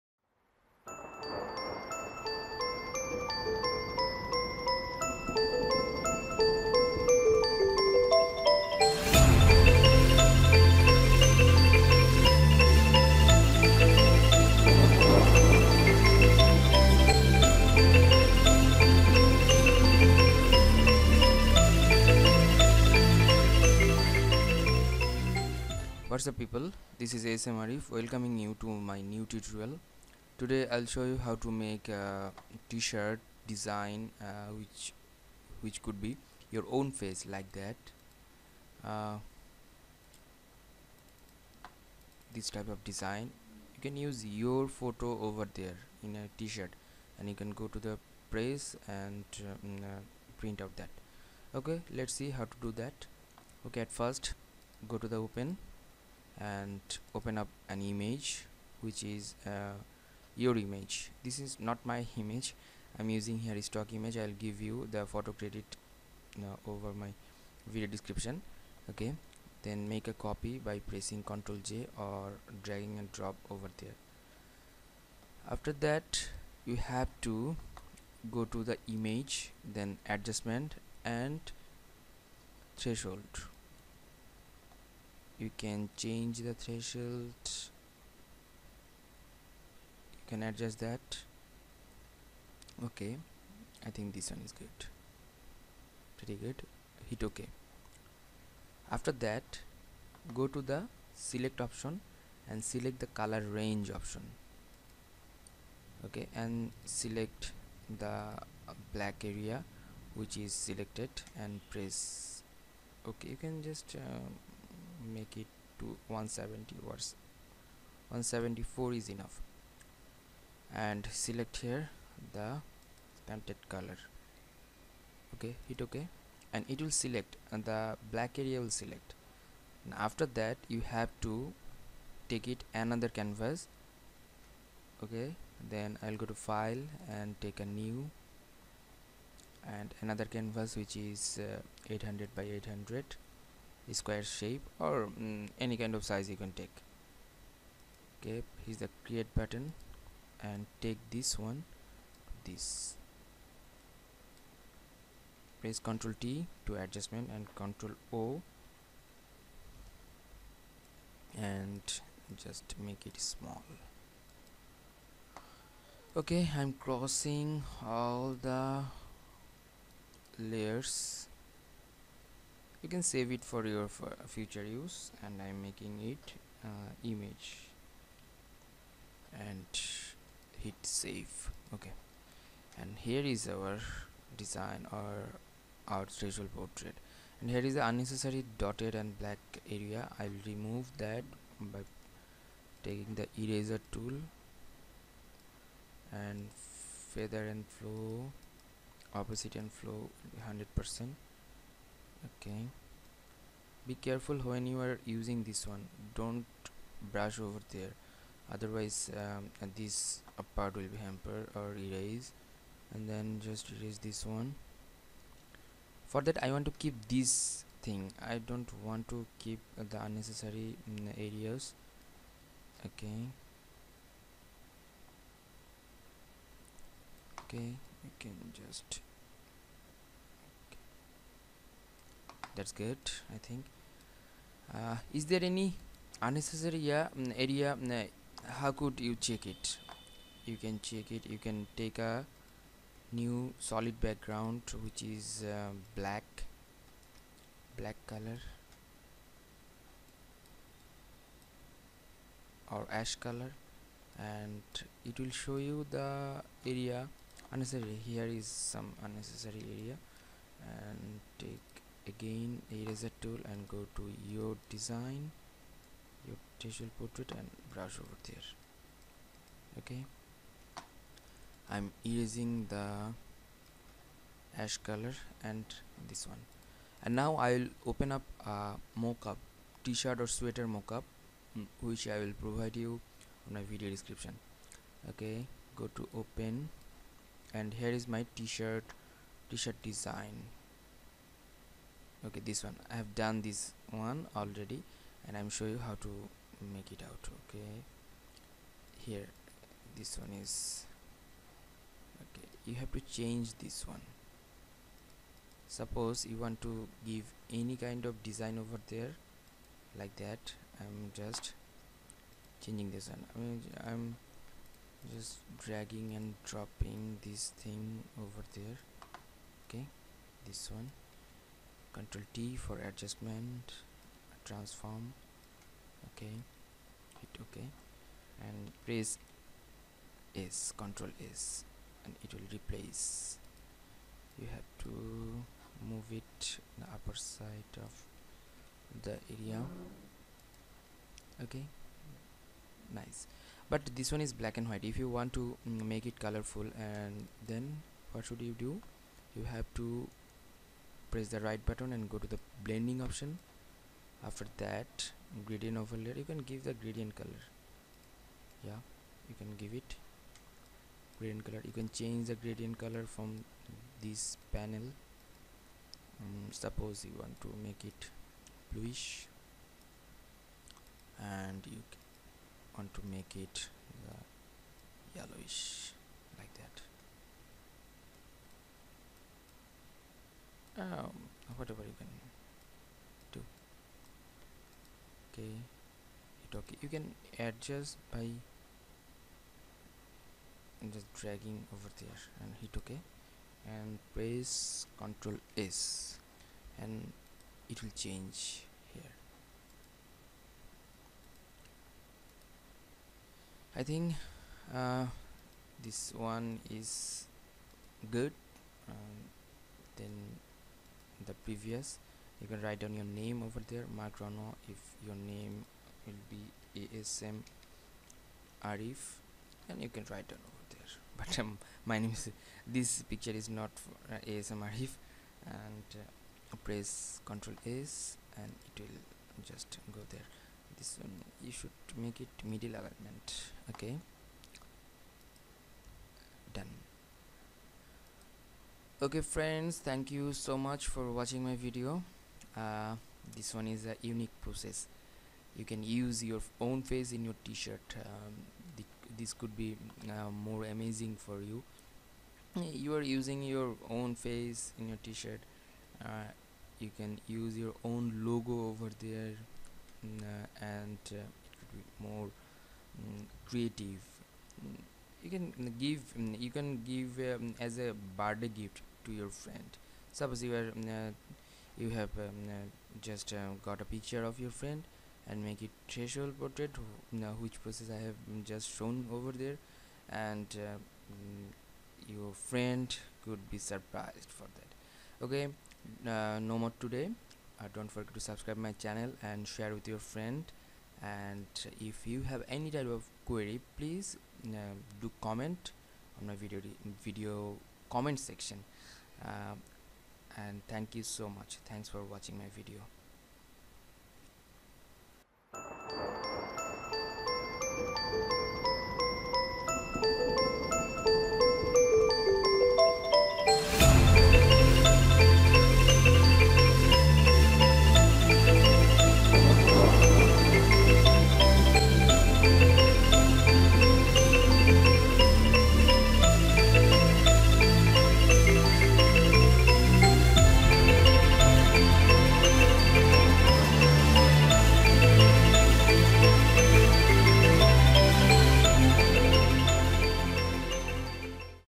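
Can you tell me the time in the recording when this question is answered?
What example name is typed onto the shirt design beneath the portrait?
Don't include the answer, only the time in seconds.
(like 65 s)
413 s.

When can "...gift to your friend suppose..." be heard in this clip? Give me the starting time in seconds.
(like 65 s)
468 s.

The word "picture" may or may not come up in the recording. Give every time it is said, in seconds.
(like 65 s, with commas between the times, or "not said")
423 s, 473 s.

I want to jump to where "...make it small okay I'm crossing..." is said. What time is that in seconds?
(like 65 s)
162 s.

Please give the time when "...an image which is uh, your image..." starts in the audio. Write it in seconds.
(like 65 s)
57 s.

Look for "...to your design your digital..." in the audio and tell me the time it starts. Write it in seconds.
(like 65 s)
263 s.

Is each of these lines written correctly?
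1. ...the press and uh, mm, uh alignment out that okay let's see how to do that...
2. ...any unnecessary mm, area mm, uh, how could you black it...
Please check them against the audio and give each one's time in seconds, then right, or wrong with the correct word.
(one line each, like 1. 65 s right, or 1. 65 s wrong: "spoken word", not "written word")
1. 47 s wrong: "print", not "alignment"
2. 235 s wrong: "check", not "black".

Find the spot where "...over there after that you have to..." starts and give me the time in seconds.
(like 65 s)
73 s.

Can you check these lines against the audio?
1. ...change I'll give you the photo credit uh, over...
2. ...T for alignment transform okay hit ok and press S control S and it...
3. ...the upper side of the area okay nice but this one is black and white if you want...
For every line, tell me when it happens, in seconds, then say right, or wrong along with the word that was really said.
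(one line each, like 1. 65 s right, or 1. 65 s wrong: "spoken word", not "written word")
1. 63 s wrong: "image", not "change"
2. 322 s wrong: "adjustment", not "alignment"
3. 336 s right.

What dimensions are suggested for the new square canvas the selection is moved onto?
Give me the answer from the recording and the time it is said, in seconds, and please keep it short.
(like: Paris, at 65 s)
800 by 800, at 141 s.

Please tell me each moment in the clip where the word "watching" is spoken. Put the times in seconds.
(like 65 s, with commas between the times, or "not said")
441 s, 502 s.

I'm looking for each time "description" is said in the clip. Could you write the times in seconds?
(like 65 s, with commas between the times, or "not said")
67 s, 283 s.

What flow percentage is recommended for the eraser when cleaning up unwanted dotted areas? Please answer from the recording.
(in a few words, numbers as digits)
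100 percent.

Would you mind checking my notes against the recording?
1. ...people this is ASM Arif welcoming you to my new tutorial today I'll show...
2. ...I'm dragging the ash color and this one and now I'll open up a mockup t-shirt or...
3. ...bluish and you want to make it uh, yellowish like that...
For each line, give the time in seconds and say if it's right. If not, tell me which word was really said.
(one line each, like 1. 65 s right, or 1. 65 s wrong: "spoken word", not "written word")
1. 26 s right
2. 271 s wrong: "erasing", not "dragging"
3. 368 s right.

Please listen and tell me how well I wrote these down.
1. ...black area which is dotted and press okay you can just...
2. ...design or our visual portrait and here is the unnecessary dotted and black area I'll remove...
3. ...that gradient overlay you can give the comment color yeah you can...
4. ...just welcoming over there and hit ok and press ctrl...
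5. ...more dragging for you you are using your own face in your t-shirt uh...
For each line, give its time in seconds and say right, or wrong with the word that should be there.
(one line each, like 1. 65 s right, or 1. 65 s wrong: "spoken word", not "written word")
1. 108 s wrong: "selected", not "dotted"
2. 184 s right
3. 354 s wrong: "gradient", not "comment"
4. 390 s wrong: "dragging", not "welcoming"
5. 450 s wrong: "amazing", not "dragging".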